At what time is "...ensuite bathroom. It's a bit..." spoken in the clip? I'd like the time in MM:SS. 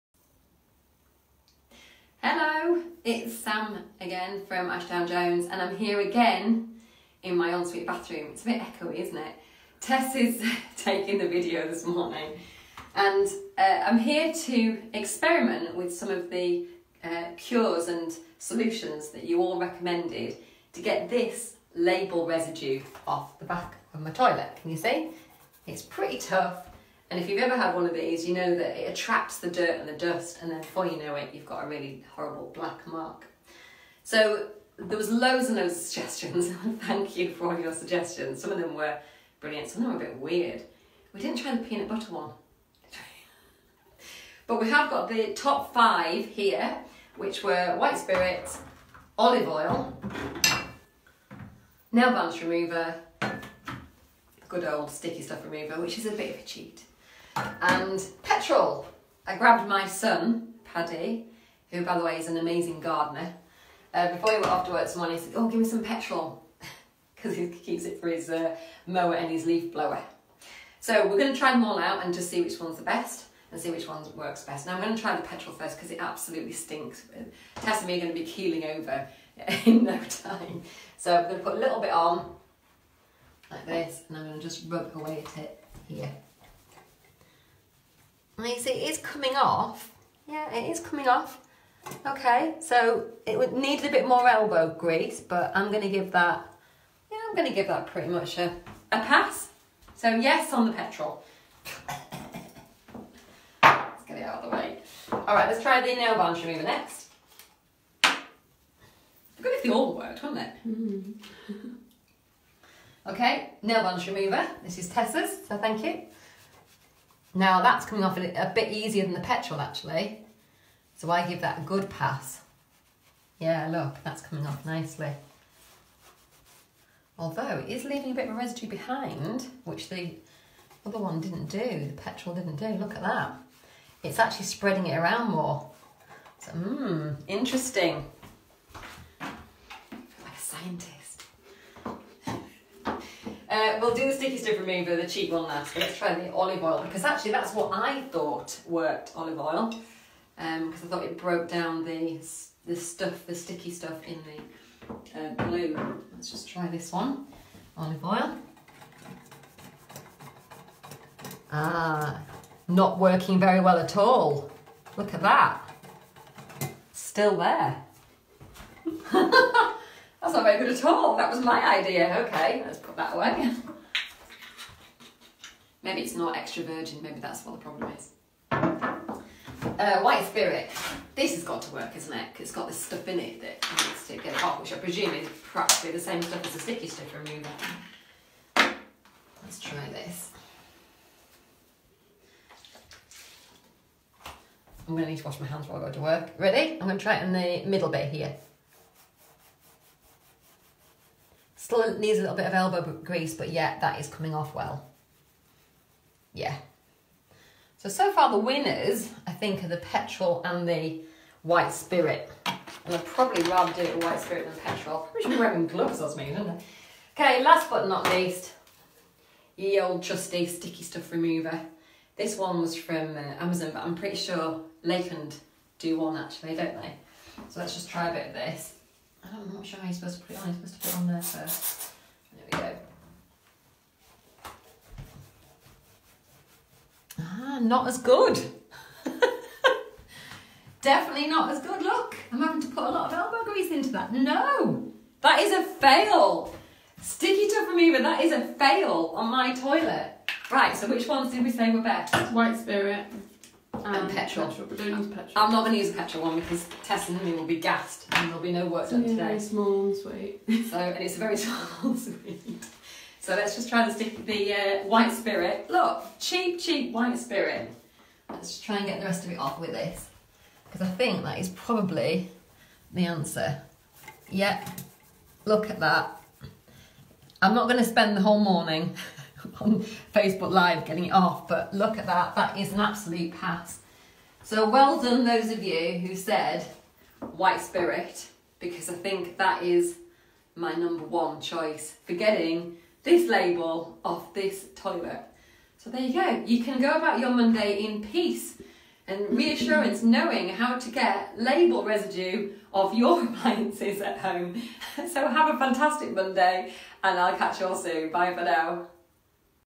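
00:07.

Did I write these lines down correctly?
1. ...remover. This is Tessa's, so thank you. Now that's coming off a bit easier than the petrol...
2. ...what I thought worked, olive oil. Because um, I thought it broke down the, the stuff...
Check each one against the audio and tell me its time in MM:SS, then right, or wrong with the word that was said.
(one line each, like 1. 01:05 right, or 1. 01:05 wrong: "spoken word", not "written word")
1. 01:54 right
2. 02:27 right.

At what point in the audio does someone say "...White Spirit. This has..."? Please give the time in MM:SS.
03:00.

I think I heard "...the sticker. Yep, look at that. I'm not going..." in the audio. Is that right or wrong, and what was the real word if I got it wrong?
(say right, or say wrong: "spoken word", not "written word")
wrong: "answer", not "sticker".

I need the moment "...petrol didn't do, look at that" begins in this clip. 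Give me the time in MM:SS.
02:11.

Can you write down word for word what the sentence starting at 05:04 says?
So have a fantastic Monday and I'll catch you all soon.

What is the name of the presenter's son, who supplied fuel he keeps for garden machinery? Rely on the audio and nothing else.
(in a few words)
Paddy.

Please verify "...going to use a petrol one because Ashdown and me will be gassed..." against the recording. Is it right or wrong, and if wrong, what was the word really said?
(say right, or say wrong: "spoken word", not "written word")
wrong: "Tess", not "Ashdown".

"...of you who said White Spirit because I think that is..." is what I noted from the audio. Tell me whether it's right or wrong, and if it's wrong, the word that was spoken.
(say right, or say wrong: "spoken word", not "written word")
right.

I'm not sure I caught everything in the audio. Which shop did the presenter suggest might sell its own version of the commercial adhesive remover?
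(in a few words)
Lakeland.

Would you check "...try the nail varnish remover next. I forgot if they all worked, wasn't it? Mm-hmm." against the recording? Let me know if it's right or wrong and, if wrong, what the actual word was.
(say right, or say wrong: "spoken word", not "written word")
right.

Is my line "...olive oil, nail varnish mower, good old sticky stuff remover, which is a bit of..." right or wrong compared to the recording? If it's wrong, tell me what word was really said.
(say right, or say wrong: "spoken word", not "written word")
wrong: "remover", not "mower".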